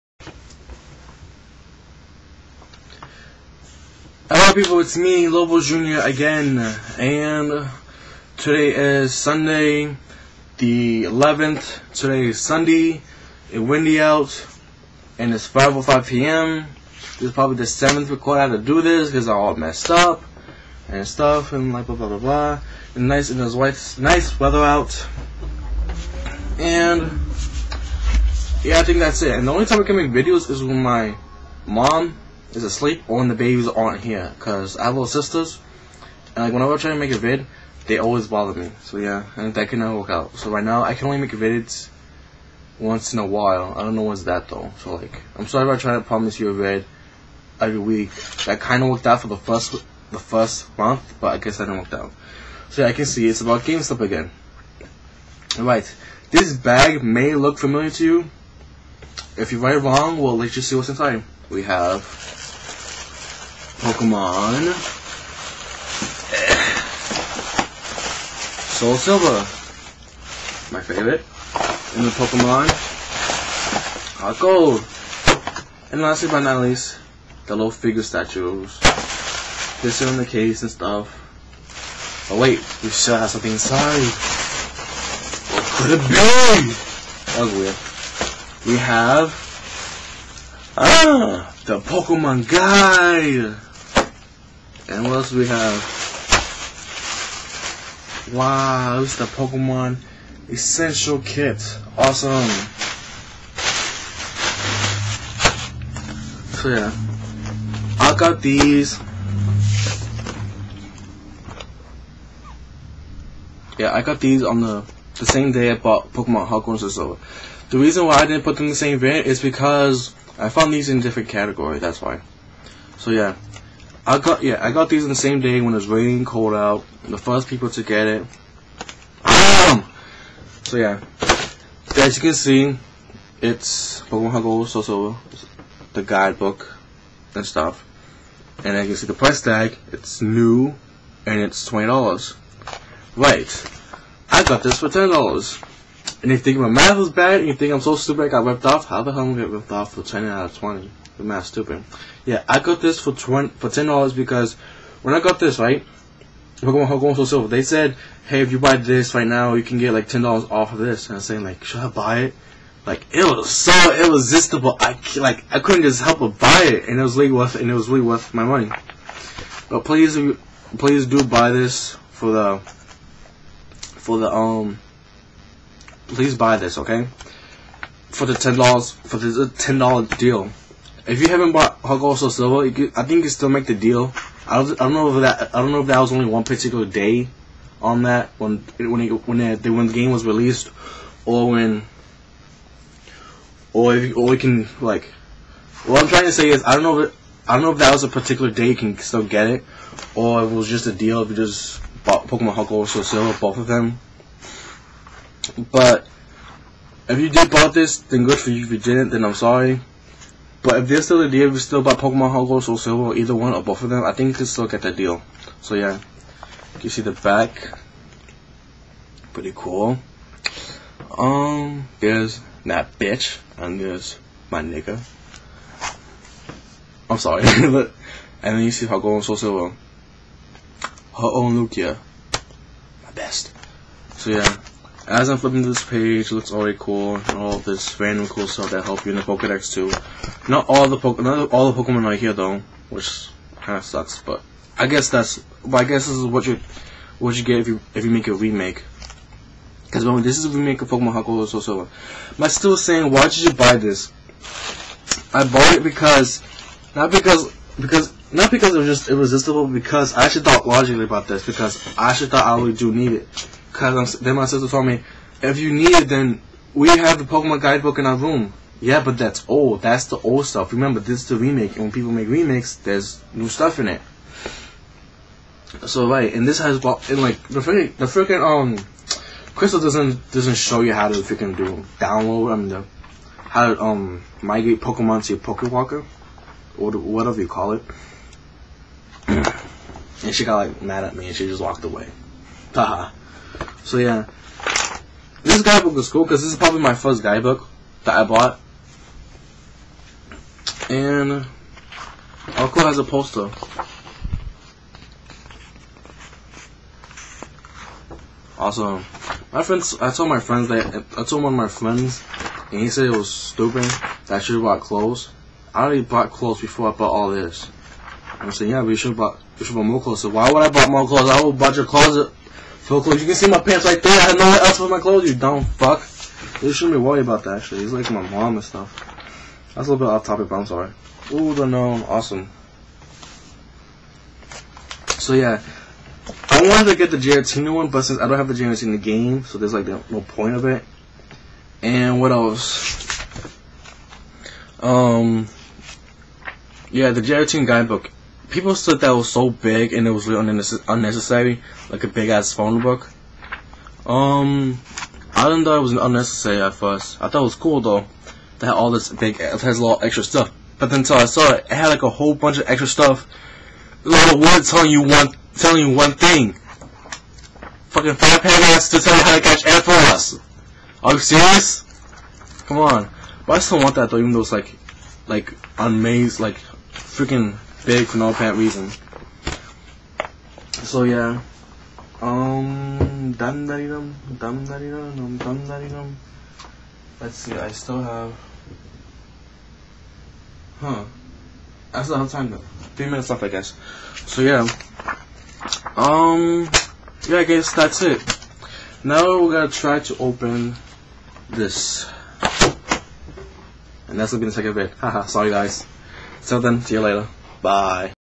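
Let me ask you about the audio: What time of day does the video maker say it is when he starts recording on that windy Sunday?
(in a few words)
5:05 p.m.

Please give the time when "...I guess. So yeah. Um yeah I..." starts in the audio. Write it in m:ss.
6:33.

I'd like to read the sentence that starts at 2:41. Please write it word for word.
And I'm saying like, should I buy it?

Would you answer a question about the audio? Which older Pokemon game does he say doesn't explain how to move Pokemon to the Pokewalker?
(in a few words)
Crystal.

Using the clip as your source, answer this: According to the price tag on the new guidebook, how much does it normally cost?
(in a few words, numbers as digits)
$20.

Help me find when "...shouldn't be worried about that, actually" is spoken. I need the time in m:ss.
5:26.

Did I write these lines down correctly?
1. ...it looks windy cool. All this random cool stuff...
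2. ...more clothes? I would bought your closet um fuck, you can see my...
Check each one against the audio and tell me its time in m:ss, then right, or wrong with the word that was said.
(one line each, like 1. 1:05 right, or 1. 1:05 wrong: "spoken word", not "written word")
1. 3:56 wrong: "already", not "windy"
2. 5:20 right.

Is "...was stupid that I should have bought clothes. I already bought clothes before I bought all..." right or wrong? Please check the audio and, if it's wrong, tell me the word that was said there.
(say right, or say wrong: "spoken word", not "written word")
right.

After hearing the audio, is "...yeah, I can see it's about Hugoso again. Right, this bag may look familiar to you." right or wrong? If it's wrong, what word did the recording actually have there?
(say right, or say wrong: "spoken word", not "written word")
wrong: "GameStop", not "Hugoso".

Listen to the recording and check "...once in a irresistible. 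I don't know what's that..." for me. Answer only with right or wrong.
wrong.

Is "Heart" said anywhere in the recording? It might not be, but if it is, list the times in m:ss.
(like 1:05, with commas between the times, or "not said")
1:14, 3:32, 3:48.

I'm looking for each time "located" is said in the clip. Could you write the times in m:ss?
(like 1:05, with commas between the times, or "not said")
not said.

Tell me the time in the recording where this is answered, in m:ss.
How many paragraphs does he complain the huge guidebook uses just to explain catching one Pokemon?
6:08.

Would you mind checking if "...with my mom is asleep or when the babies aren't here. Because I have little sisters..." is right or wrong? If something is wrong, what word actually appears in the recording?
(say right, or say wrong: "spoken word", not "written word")
right.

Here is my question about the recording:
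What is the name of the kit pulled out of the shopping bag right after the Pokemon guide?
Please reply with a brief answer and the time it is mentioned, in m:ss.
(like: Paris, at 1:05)
Pokemon Essential Kit, at 1:39.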